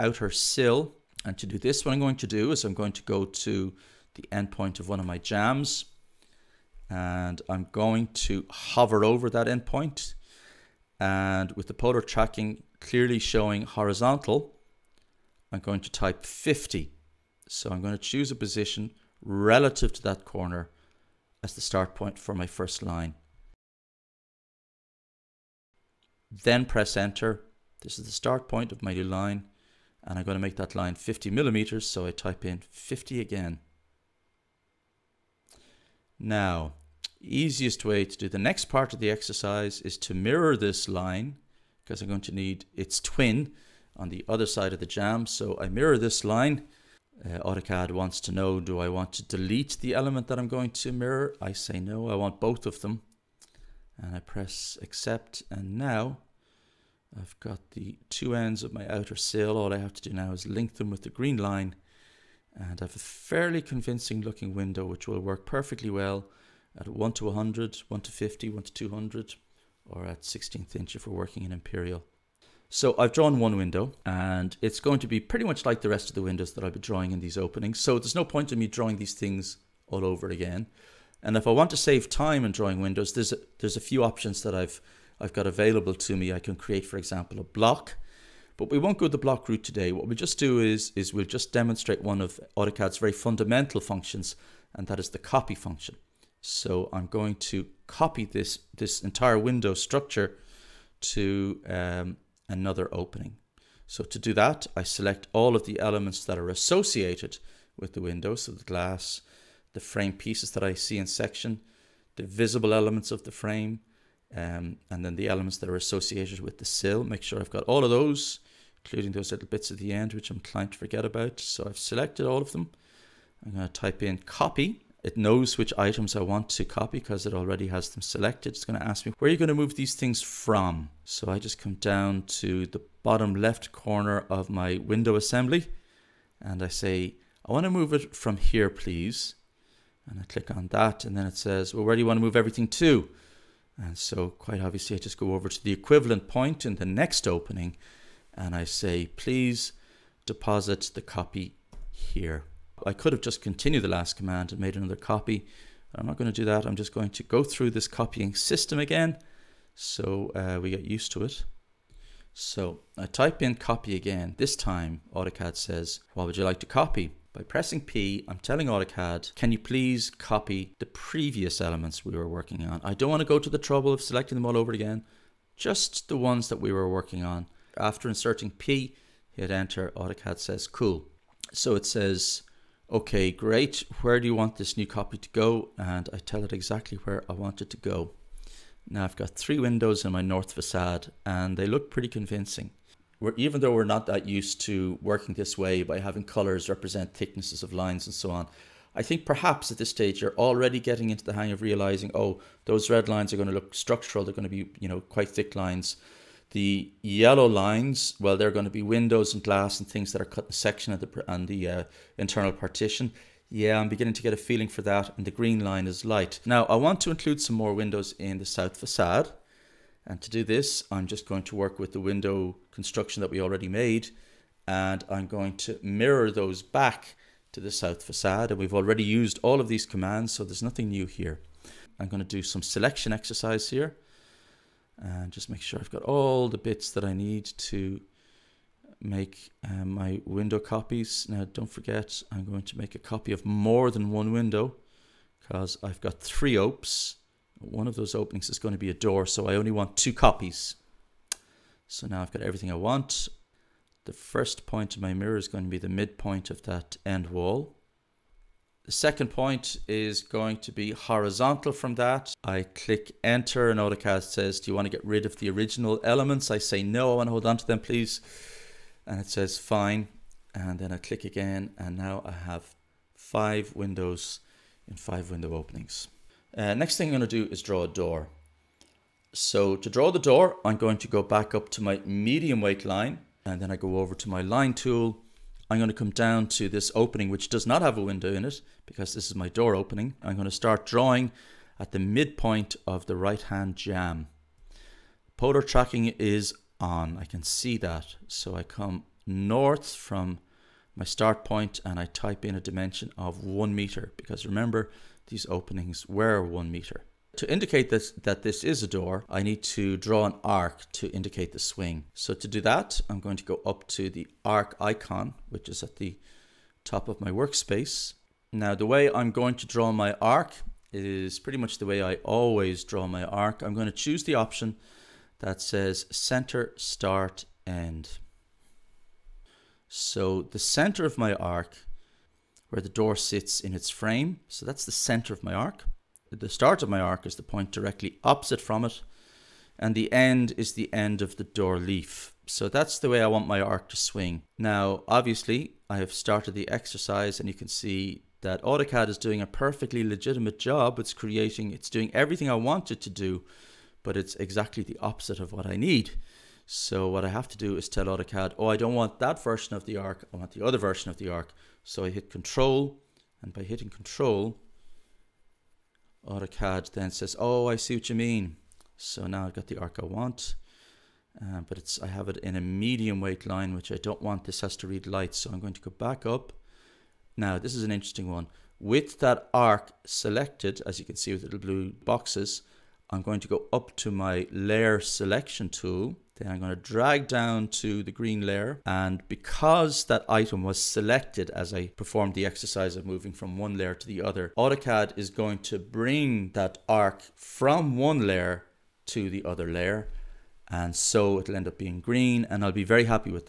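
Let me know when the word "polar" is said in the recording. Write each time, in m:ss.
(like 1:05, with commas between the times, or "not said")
0:11, 4:55.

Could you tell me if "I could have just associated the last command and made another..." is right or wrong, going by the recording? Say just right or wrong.
wrong.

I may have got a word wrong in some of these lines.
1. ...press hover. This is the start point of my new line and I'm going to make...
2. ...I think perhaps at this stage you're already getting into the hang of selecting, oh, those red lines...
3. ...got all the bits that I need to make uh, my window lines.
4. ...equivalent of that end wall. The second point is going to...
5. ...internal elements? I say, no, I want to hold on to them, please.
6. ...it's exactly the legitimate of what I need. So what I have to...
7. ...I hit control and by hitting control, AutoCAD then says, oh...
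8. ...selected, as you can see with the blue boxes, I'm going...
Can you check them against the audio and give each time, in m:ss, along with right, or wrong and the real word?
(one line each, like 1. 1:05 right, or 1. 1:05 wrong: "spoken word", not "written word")
1. 0:26 wrong: "enter", not "hover"
2. 3:18 wrong: "realizing", not "selecting"
3. 3:55 wrong: "copies", not "lines"
4. 4:15 wrong: "midpoint", not "equivalent"
5. 4:25 wrong: "original", not "internal"
6. 5:54 wrong: "opposite", not "legitimate"
7. 6:02 right
8. 6:20 right.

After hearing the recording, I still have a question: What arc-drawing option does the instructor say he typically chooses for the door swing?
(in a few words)
Center, start, end.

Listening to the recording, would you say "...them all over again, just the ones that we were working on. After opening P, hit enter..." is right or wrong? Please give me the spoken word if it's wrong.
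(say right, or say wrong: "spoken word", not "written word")
wrong: "inserting", not "opening".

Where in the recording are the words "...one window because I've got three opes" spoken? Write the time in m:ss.
4:04.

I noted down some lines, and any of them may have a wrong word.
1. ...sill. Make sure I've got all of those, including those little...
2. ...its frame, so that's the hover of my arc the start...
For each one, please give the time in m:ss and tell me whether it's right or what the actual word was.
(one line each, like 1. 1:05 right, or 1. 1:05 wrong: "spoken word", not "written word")
1. 1:56 right
2. 5:33 wrong: "center", not "hover".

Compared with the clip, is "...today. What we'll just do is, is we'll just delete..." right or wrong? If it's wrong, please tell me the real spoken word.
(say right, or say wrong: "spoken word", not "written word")
wrong: "demonstrate", not "delete".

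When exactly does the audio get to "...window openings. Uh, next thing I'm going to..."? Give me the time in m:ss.
4:35.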